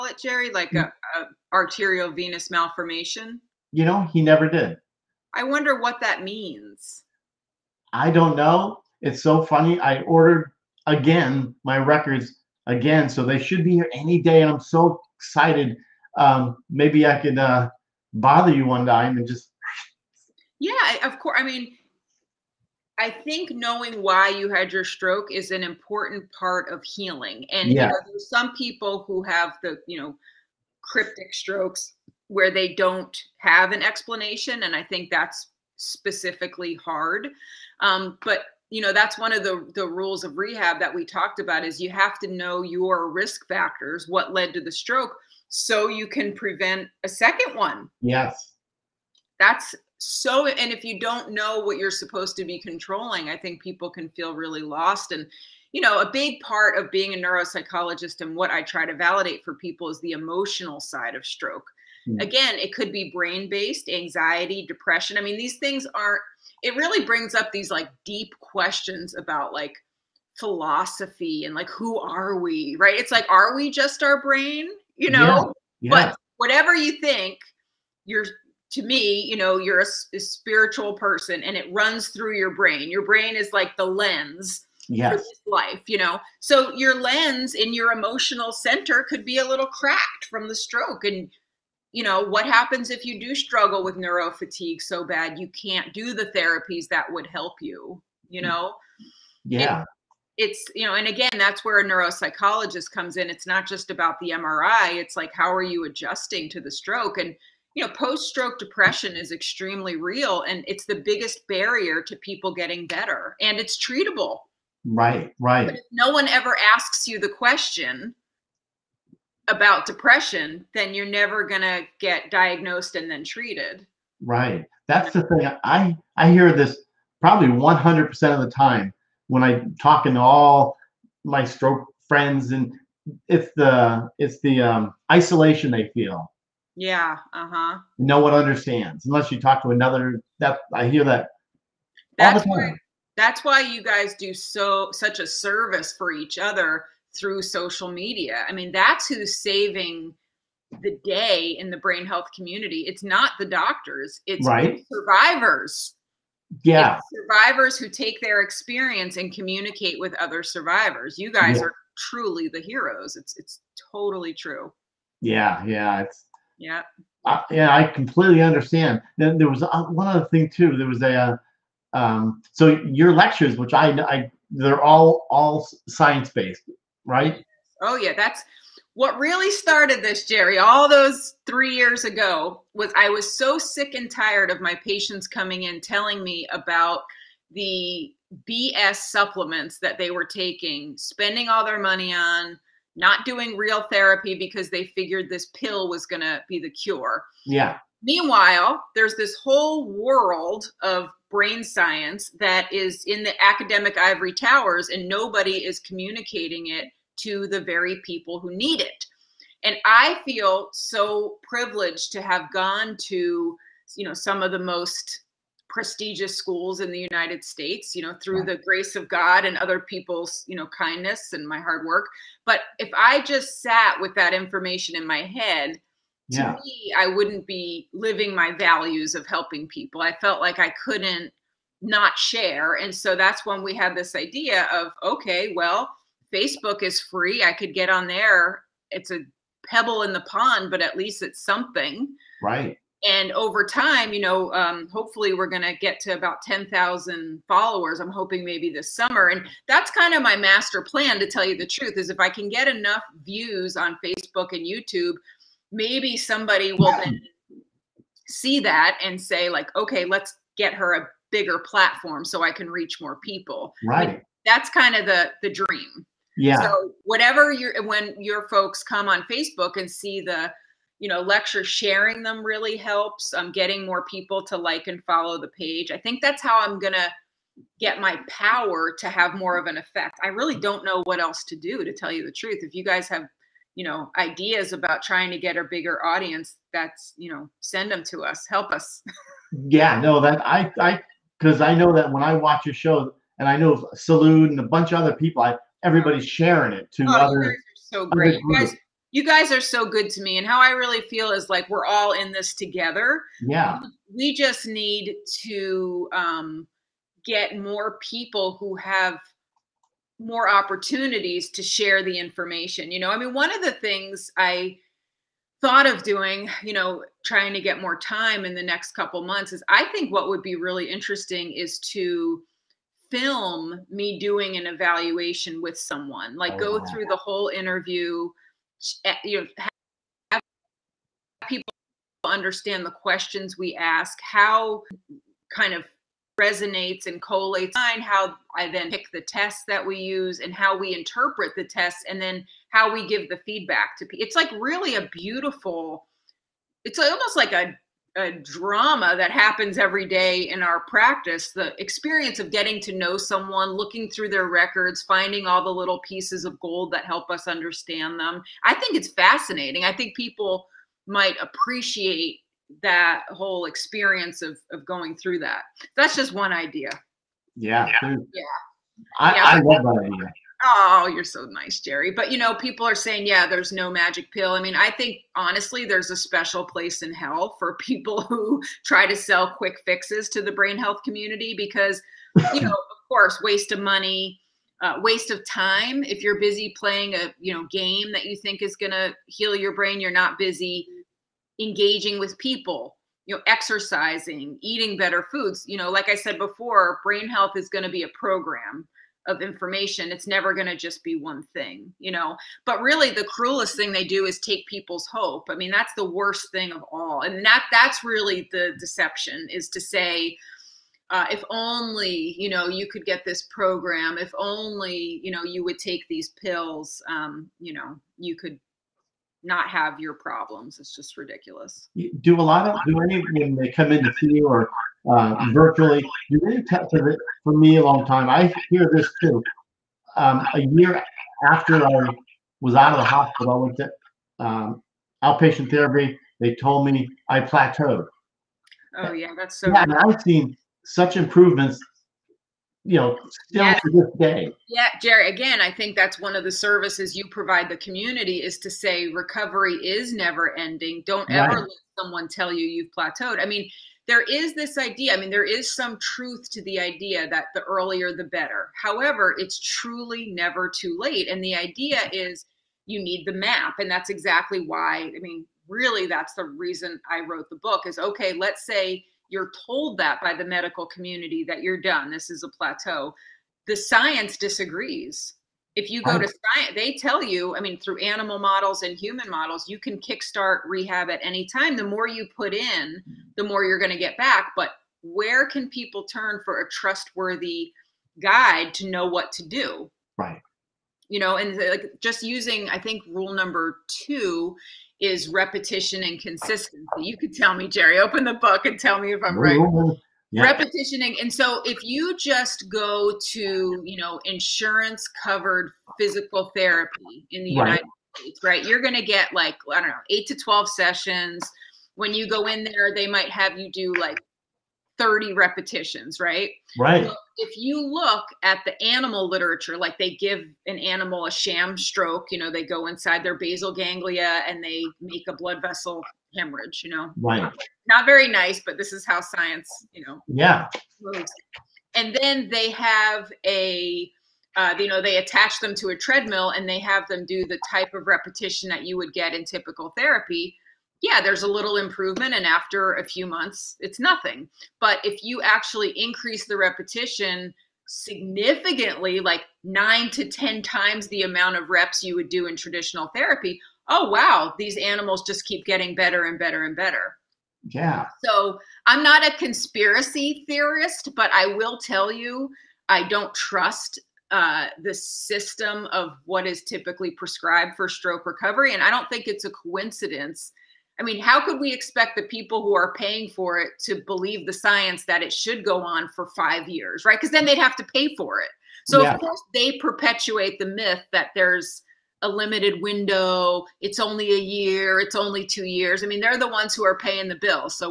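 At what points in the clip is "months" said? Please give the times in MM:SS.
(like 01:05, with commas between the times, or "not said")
05:19, 09:03.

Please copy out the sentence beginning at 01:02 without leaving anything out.
Again, it could be brain based, anxiety, depression.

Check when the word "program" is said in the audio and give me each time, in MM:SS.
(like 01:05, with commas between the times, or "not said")
06:38, 06:53.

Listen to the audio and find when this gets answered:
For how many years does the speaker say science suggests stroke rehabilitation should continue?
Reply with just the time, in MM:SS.
09:36.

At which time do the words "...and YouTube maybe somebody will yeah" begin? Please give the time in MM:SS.
04:14.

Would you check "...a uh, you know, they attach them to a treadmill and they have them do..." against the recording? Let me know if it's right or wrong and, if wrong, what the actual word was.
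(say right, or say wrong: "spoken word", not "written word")
right.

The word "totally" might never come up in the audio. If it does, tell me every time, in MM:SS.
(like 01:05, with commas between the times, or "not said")
02:43.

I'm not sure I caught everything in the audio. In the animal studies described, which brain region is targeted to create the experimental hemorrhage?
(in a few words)
basal ganglia.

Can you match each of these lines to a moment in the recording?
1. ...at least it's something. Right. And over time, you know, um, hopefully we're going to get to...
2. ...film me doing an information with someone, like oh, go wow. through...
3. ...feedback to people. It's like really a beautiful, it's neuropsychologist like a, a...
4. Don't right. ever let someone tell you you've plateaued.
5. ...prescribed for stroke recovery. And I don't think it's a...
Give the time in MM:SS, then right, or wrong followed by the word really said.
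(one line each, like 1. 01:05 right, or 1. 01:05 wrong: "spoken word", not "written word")
1. 04:00 right
2. 05:23 wrong: "evaluation", not "information"
3. 05:43 wrong: "almost", not "neuropsychologist"
4. 07:31 right
5. 09:27 right.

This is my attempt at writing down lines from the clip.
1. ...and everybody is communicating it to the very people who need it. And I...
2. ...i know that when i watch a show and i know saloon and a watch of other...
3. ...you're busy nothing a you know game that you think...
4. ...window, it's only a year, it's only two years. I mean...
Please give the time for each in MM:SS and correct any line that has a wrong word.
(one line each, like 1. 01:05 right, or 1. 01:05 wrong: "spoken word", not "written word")
1. 03:24 wrong: "nobody", not "everybody"
2. 04:51 wrong: "bunch", not "watch"
3. 06:26 wrong: "playing", not "nothing"
4. 09:42 right.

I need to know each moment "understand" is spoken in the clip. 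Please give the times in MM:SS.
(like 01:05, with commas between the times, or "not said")
02:18, 02:48, 05:32, 05:57.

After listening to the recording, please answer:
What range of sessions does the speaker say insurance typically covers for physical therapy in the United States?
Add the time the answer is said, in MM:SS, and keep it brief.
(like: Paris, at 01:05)
8 to 12, at 08:30.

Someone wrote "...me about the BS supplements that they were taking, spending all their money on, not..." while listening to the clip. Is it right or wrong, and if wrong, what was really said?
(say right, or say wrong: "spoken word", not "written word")
right.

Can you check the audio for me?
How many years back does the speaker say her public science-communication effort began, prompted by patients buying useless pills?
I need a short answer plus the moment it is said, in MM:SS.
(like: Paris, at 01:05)
3, at 03:01.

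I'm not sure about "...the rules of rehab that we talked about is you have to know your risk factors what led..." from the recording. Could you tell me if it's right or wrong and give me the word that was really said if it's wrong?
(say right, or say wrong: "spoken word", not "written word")
right.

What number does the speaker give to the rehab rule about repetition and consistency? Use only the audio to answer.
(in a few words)
2.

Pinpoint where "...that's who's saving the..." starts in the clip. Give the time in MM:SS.
02:28.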